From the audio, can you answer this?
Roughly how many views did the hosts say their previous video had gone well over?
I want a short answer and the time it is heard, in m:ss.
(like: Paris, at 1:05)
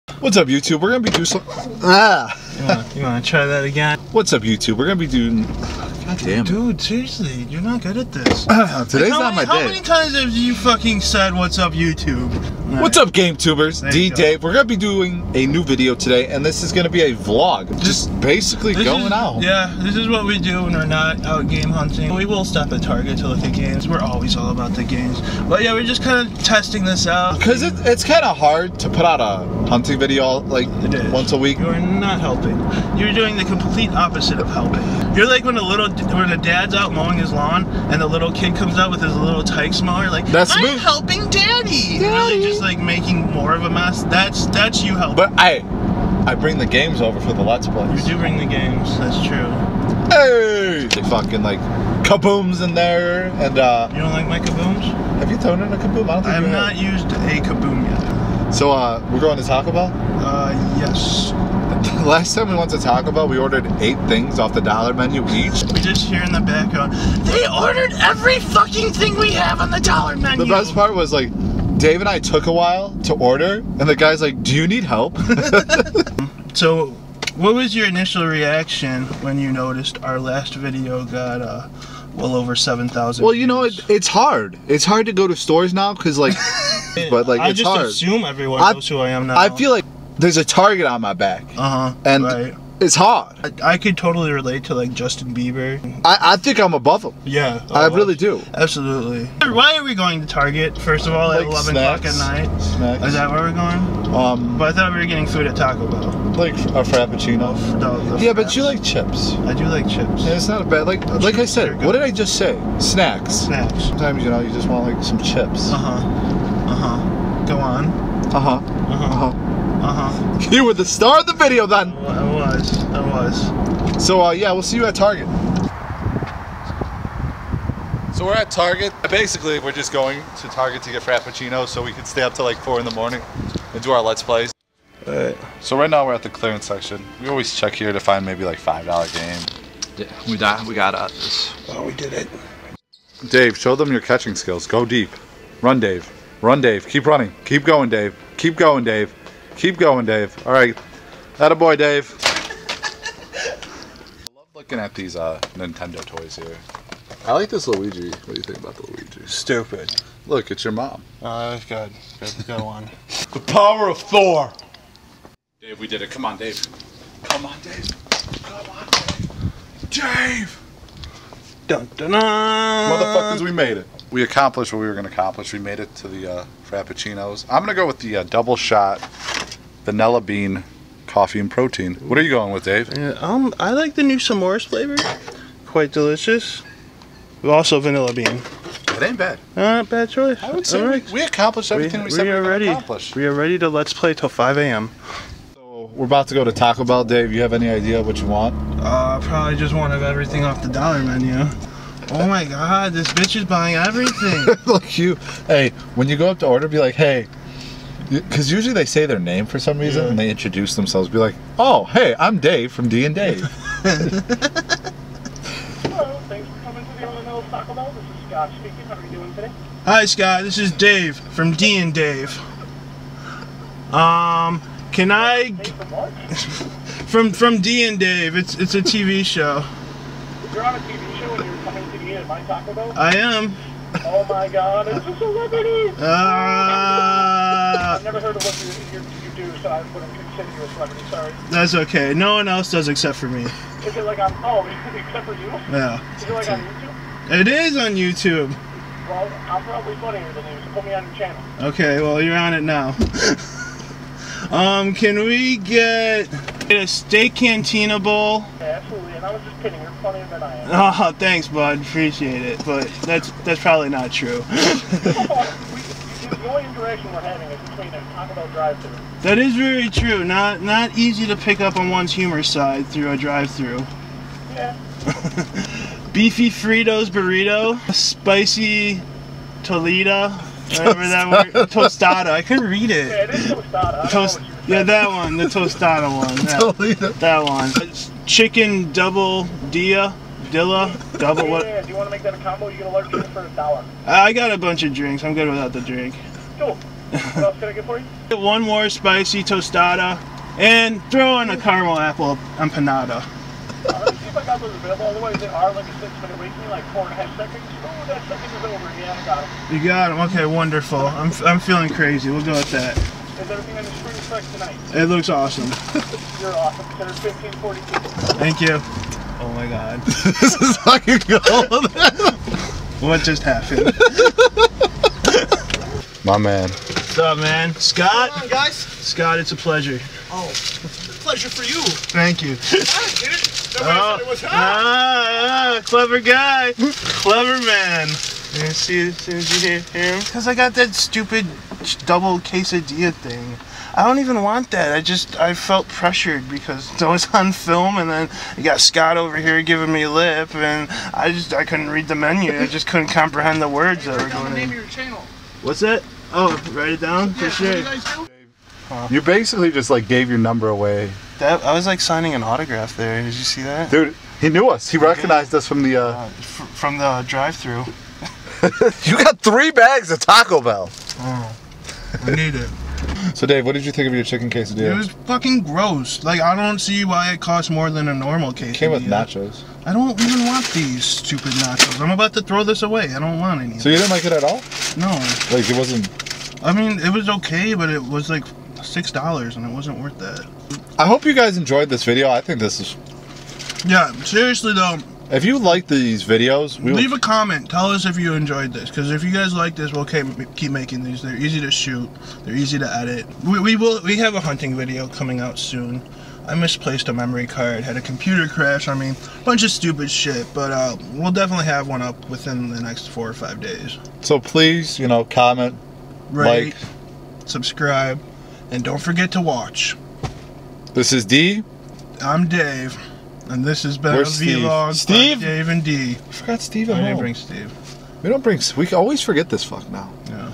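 7000, at 1:22.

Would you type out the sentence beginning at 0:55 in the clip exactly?
Have you thrown in a kaboom?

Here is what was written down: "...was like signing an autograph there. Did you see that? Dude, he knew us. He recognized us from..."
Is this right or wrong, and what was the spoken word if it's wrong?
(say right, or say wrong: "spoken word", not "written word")
right.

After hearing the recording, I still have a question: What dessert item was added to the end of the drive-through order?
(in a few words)
Caramel apple empanada.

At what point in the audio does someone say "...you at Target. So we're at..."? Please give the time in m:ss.
2:04.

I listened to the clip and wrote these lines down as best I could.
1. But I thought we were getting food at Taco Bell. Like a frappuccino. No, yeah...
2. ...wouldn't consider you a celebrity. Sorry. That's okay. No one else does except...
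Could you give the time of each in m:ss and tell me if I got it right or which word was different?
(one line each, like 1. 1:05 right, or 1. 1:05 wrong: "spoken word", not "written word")
1. 1:44 right
2. 3:59 right.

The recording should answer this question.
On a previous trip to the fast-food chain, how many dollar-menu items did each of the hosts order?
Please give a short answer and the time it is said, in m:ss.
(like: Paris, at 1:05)
8, at 1:03.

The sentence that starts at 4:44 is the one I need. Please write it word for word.
Toast, yeah, that one, the tostada one.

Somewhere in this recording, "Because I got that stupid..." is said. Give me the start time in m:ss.
5:40.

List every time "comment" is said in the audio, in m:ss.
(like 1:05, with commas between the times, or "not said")
6:37, 6:55.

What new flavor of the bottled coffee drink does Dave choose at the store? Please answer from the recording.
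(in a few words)
S'mores.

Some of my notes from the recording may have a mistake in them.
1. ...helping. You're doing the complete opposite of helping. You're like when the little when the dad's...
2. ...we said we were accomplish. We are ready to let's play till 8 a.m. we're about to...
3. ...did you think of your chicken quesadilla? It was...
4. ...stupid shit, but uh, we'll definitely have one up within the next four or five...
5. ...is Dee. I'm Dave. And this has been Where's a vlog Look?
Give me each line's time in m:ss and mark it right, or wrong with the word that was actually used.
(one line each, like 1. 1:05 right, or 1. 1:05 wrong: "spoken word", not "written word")
1. 0:32 right
2. 3:12 wrong: "5", not "8"
3. 6:13 right
4. 6:49 right
5. 7:01 wrong: "Steve", not "Look".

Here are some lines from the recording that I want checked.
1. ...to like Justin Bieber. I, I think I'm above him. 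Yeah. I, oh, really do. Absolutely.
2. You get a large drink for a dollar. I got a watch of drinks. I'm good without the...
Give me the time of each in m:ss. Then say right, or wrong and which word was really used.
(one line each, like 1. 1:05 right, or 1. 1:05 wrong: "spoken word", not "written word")
1. 1:34 right
2. 4:52 wrong: "bunch", not "watch".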